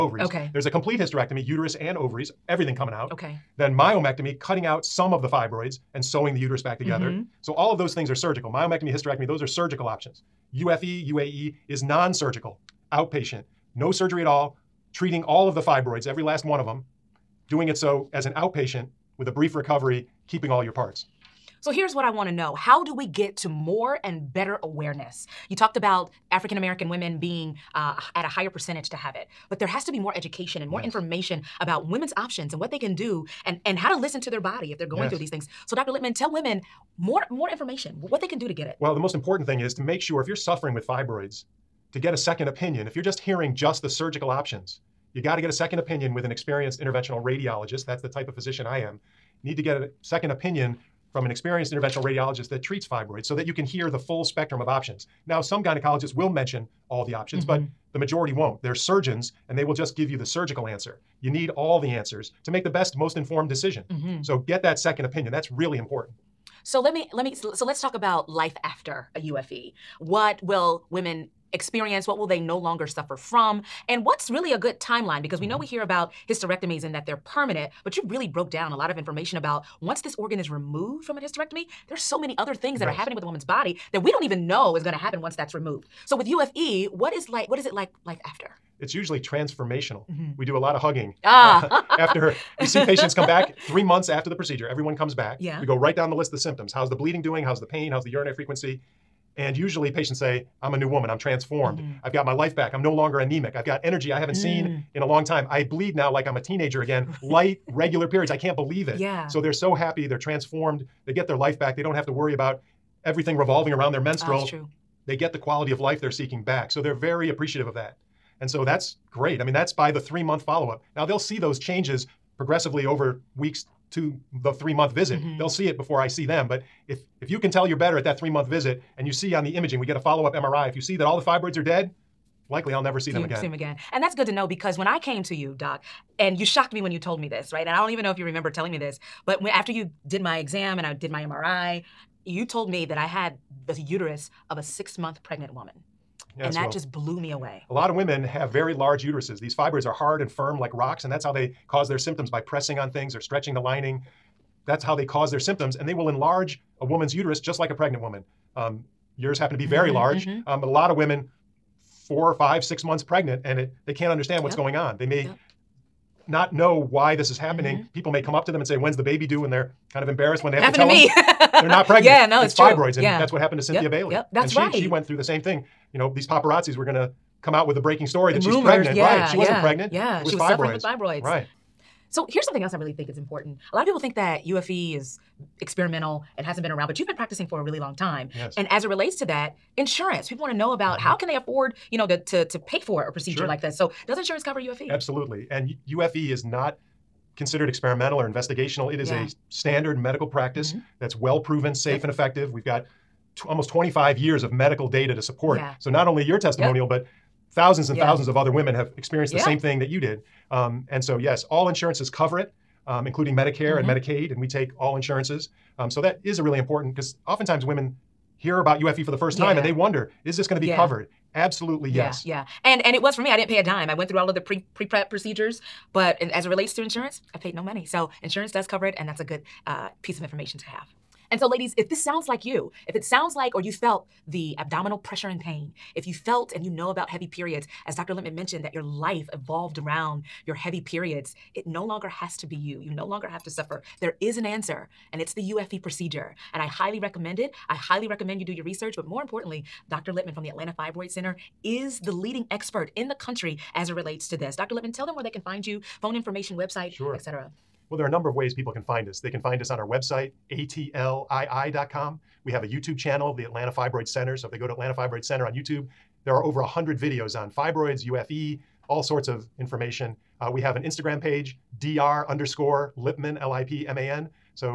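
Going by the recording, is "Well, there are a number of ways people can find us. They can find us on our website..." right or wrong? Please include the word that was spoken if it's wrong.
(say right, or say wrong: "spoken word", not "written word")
right.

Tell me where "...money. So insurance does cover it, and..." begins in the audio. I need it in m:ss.
3:47.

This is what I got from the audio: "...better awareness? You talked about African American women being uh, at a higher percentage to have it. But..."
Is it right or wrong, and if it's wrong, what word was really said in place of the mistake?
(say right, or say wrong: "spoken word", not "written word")
right.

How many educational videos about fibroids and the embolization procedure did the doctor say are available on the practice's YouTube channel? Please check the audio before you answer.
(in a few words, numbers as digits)
over 100.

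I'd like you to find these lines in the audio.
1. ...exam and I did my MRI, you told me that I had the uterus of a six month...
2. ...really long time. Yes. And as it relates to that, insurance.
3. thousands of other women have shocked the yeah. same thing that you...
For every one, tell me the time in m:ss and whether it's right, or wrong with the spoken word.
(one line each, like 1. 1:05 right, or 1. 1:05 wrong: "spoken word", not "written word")
1. 2:20 right
2. 3:07 right
3. 3:28 wrong: "experienced", not "shocked".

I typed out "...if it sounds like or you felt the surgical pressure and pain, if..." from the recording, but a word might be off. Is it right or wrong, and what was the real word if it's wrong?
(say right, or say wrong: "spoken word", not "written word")
wrong: "abdominal", not "surgical".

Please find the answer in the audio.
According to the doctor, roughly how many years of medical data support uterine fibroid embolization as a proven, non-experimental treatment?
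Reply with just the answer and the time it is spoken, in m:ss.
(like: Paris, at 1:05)
almost 25 years, at 3:23.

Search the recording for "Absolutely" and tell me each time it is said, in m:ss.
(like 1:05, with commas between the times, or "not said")
3:14, 3:41.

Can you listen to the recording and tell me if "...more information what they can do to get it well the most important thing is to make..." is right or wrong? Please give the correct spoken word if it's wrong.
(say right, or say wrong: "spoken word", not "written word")
right.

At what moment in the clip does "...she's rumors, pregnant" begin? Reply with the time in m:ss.
2:58.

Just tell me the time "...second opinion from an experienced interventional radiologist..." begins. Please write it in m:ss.
0:50.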